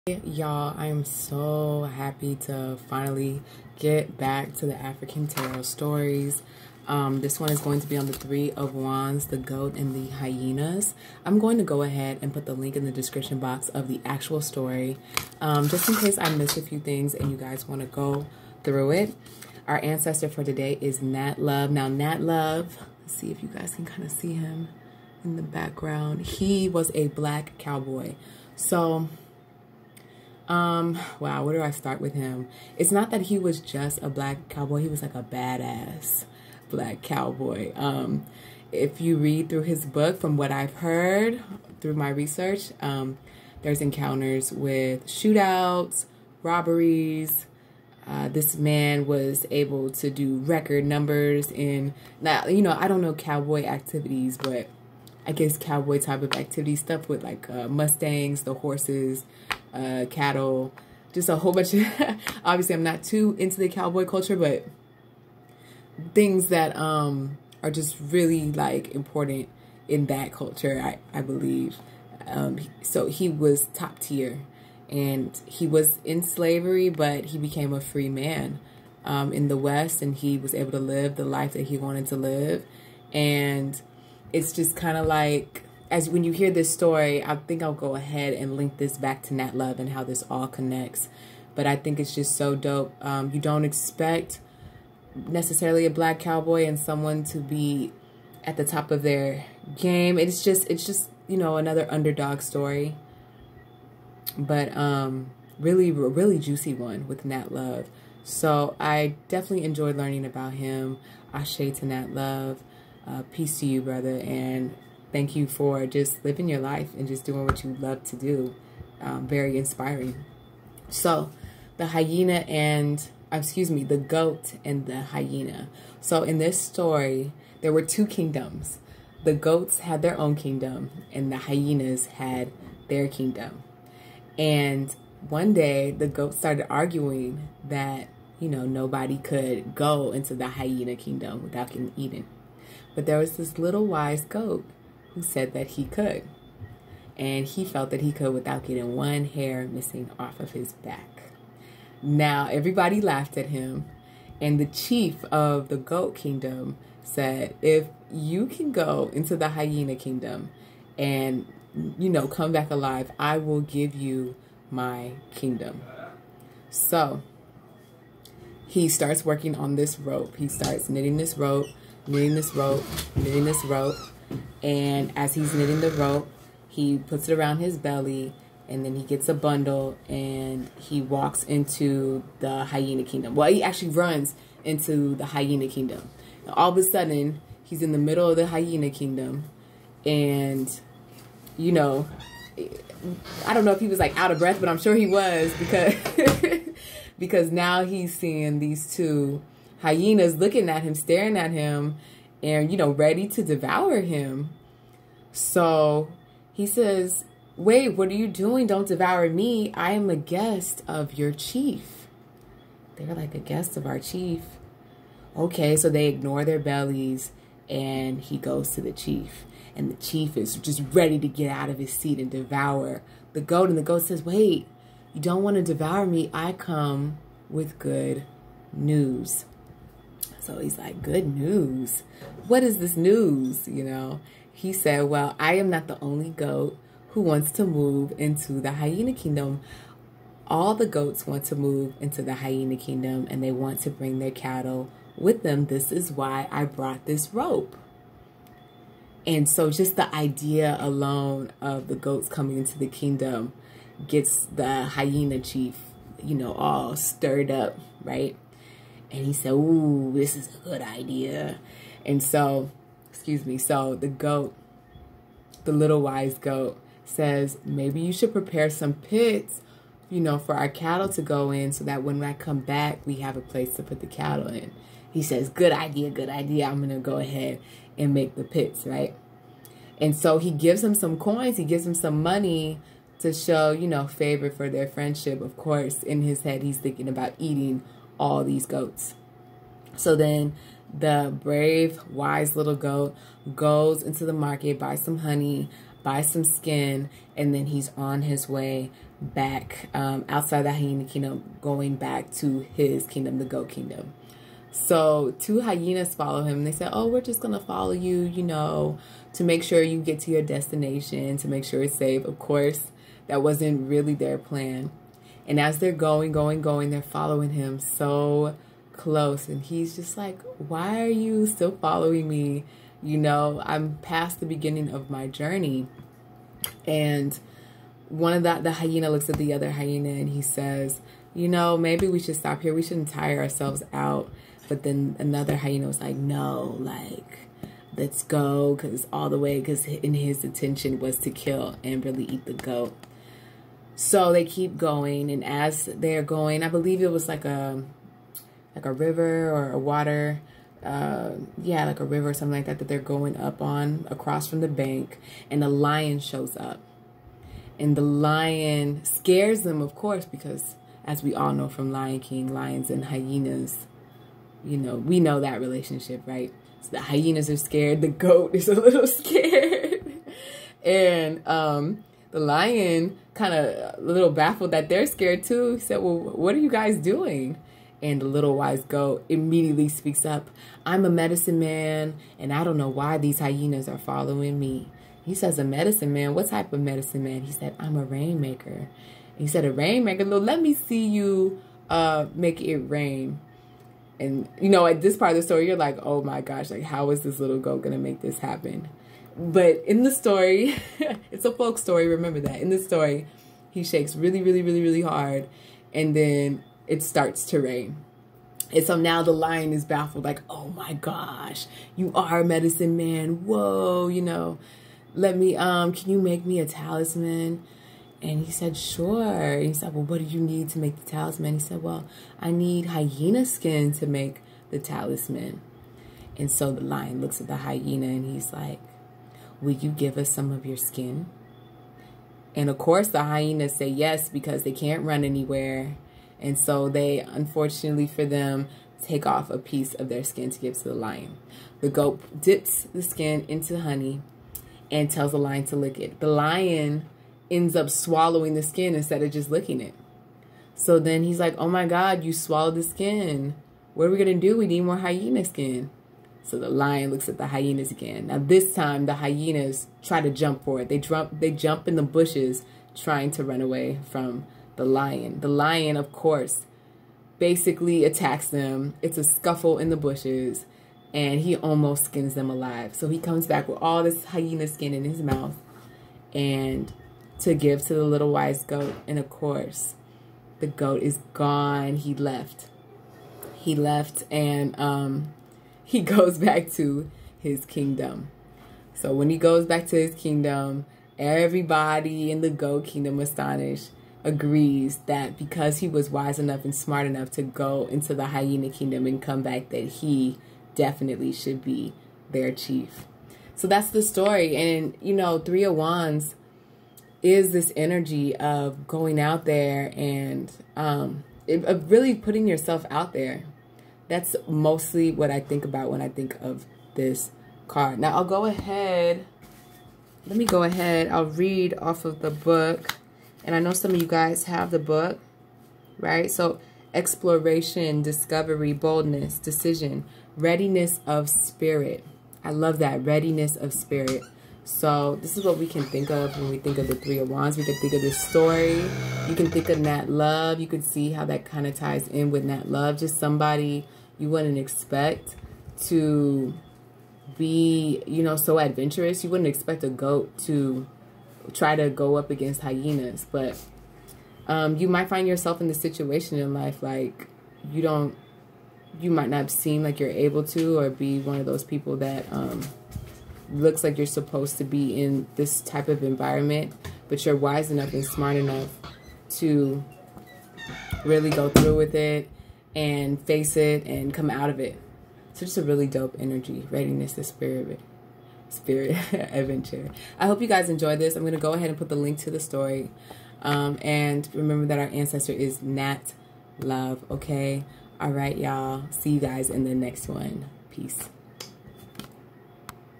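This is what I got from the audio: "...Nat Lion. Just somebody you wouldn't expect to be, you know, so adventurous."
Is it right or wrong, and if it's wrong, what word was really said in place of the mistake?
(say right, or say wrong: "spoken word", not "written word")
wrong: "Love", not "Lion".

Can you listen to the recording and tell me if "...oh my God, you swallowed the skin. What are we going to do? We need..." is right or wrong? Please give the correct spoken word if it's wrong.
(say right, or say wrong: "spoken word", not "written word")
right.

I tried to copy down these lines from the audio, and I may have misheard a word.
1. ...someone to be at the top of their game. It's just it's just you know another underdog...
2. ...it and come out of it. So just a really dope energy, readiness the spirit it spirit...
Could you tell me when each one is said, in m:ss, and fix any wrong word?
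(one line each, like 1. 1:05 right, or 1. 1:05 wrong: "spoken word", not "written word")
1. 1:36 right
2. 9:33 right.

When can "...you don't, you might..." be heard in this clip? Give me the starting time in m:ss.
9:17.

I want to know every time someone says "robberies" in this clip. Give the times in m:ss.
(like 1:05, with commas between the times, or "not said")
0:46.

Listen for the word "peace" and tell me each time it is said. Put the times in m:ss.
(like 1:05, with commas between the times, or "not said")
1:53, 9:50.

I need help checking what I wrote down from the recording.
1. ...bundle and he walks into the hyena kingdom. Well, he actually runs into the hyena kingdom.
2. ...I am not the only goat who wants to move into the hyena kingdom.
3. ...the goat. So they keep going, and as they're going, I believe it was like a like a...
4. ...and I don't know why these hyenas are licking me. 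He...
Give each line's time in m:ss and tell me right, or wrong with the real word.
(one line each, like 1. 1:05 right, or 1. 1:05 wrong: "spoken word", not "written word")
1. 2:59 right
2. 3:55 right
3. 5:42 right
4. 6:22 wrong: "following", not "licking".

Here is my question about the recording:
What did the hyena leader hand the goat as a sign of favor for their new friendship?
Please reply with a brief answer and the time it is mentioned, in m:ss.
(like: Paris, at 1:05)
coins, at 4:41.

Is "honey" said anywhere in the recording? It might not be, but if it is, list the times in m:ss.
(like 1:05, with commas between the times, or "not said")
4:55, 7:23.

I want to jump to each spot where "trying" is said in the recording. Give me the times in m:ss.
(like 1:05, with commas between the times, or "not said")
7:42.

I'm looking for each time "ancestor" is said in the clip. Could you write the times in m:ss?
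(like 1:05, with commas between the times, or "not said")
0:19, 9:44.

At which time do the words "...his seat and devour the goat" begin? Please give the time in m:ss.
3:41.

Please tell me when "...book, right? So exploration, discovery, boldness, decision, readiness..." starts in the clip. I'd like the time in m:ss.
8:44.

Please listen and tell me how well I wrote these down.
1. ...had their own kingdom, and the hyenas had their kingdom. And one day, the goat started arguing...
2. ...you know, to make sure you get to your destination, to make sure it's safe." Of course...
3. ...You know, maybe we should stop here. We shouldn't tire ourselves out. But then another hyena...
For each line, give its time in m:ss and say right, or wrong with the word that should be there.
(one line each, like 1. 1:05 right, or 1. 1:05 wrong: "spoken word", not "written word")
1. 2:09 right
2. 5:08 right
3. 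5:31 right.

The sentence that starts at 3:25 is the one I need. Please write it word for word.
So he says, Wait, what are you doing?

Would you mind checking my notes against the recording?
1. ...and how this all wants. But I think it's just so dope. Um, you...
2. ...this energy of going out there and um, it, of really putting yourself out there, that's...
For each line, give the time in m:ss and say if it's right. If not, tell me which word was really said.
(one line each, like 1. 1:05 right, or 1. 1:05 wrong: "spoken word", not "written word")
1. 1:29 wrong: "connects", not "wants"
2. 8:27 right.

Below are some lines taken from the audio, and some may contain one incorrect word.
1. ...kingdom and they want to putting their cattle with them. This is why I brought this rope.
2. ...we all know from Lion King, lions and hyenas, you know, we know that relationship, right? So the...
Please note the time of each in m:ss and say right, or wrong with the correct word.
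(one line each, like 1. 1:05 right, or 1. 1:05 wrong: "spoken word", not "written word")
1. 4:02 wrong: "bring", not "putting"
2. 6:01 right.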